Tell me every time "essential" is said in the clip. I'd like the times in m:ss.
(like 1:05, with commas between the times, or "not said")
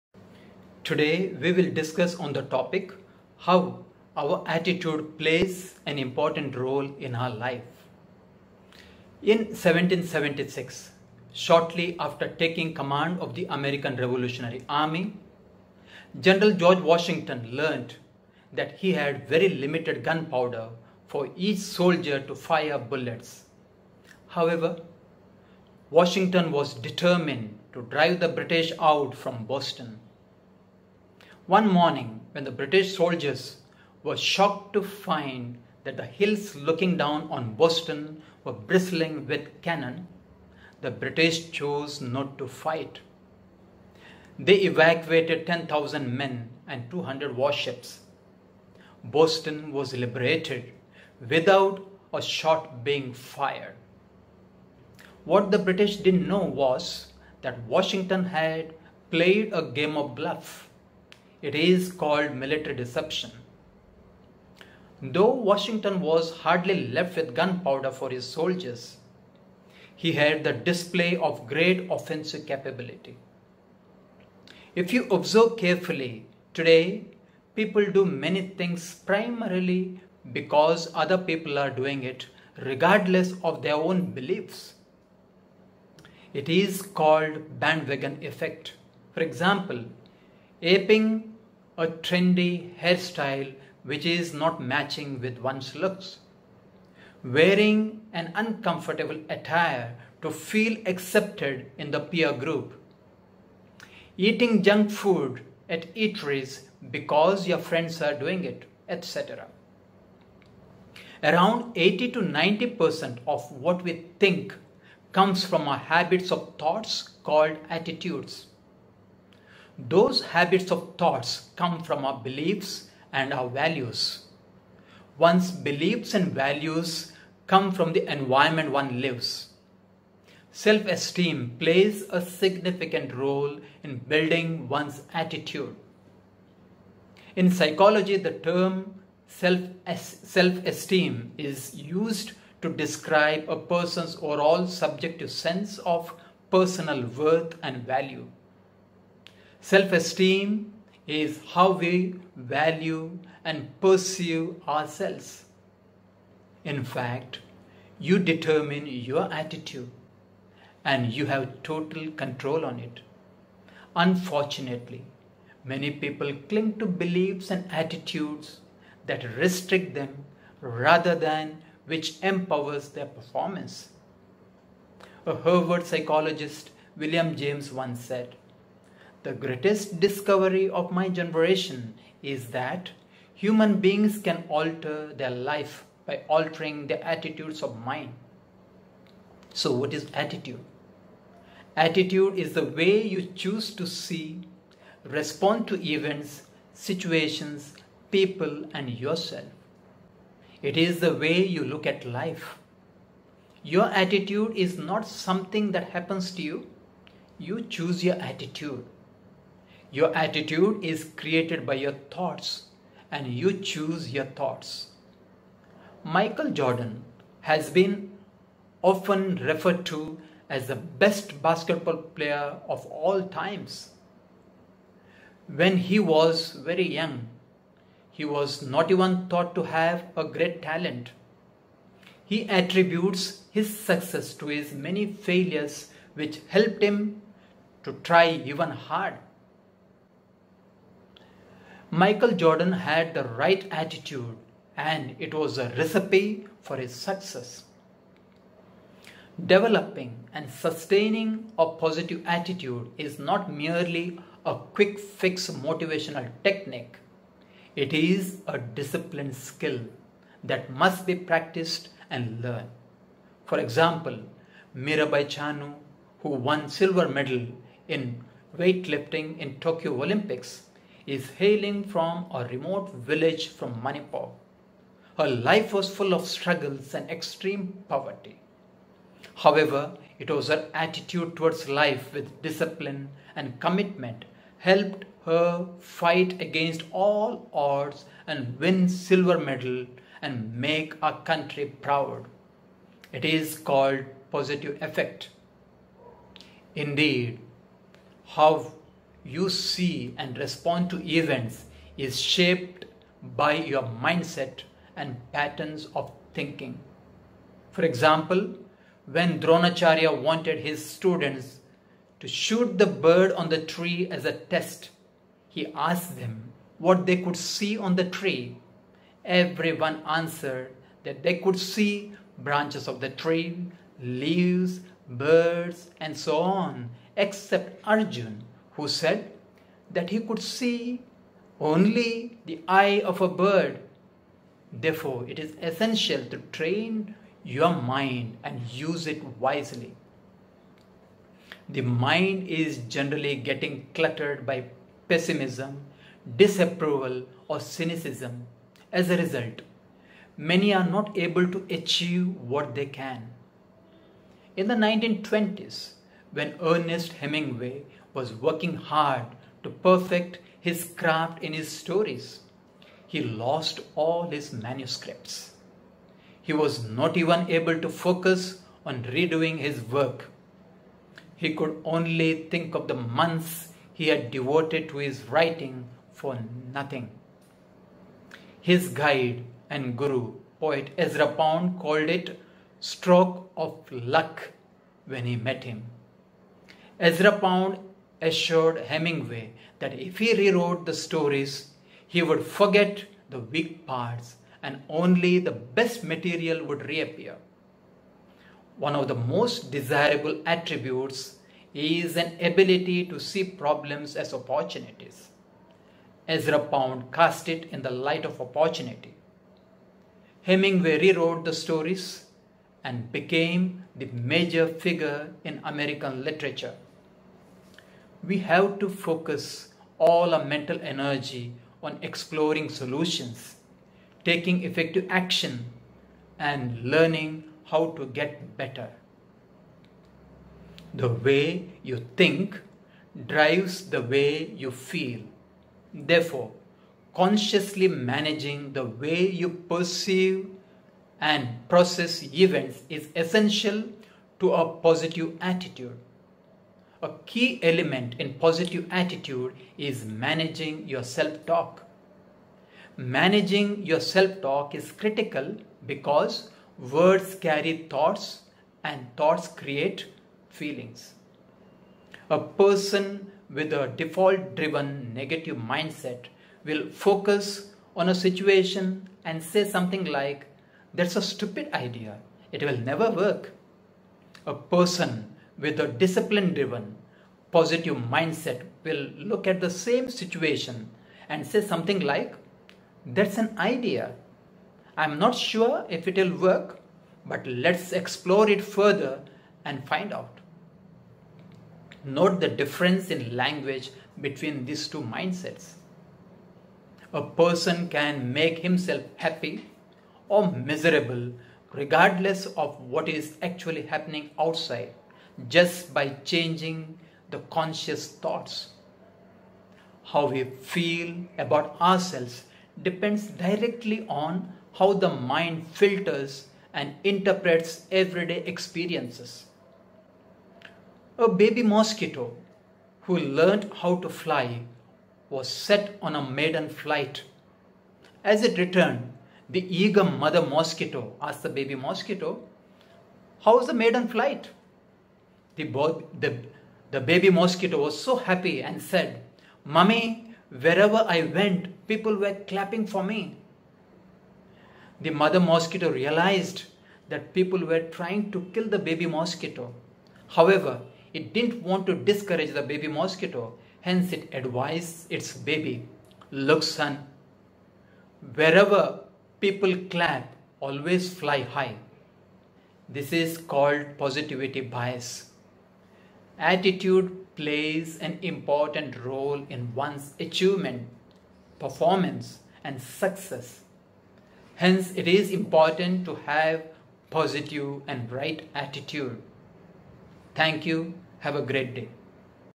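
5:35, 7:23.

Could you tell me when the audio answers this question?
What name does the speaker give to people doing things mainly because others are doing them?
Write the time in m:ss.
1:27.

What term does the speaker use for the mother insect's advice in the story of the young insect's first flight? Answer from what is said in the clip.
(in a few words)
positivity bias.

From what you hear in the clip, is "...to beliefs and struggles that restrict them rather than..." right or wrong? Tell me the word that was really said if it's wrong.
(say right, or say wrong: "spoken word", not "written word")
wrong: "attitudes", not "struggles".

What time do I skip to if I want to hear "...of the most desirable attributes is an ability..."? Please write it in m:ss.
6:38.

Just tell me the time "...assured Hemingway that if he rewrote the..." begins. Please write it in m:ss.
6:28.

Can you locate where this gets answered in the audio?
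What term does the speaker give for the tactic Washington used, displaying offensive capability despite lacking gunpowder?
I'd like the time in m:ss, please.
1:02.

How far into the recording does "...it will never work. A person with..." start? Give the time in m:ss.
7:52.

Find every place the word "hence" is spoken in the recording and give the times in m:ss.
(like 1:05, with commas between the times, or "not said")
9:13, 9:34.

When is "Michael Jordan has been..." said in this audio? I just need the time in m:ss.
3:36.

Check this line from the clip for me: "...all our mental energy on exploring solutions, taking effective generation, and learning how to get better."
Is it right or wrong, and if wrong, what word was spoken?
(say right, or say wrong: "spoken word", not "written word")
wrong: "action", not "generation".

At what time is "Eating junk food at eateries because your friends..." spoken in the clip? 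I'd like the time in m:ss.
1:44.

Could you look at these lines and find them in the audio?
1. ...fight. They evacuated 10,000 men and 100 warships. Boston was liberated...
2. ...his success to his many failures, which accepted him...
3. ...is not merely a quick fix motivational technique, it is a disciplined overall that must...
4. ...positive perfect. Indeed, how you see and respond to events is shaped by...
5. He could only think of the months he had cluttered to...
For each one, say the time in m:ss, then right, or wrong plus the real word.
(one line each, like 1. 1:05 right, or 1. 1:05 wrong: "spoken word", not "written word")
1. 0:42 wrong: "200", not "100"
2. 3:53 wrong: "helped", not "accepted"
3. 4:12 wrong: "skill", not "overall"
4. 4:54 wrong: "effect", not "perfect"
5. 6:11 wrong: "devoted", not "cluttered".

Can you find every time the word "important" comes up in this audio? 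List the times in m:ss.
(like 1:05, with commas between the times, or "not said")
0:05, 9:28, 9:35.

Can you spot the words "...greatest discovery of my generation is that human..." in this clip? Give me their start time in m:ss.
2:59.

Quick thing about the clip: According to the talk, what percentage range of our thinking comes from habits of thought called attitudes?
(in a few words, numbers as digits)
80 to 90%.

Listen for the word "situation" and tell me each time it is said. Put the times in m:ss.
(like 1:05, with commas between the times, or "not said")
3:16, 7:48, 8:00.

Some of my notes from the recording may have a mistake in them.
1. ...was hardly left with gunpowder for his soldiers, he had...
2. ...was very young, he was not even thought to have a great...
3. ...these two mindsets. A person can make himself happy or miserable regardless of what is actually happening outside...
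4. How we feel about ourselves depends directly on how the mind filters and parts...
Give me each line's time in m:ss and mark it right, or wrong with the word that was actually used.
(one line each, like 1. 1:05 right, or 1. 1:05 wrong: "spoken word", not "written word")
1. 1:05 right
2. 3:45 right
3. 8:14 right
4. 8:30 wrong: "interprets", not "parts".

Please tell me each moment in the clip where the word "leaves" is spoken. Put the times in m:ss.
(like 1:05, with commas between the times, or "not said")
5:24.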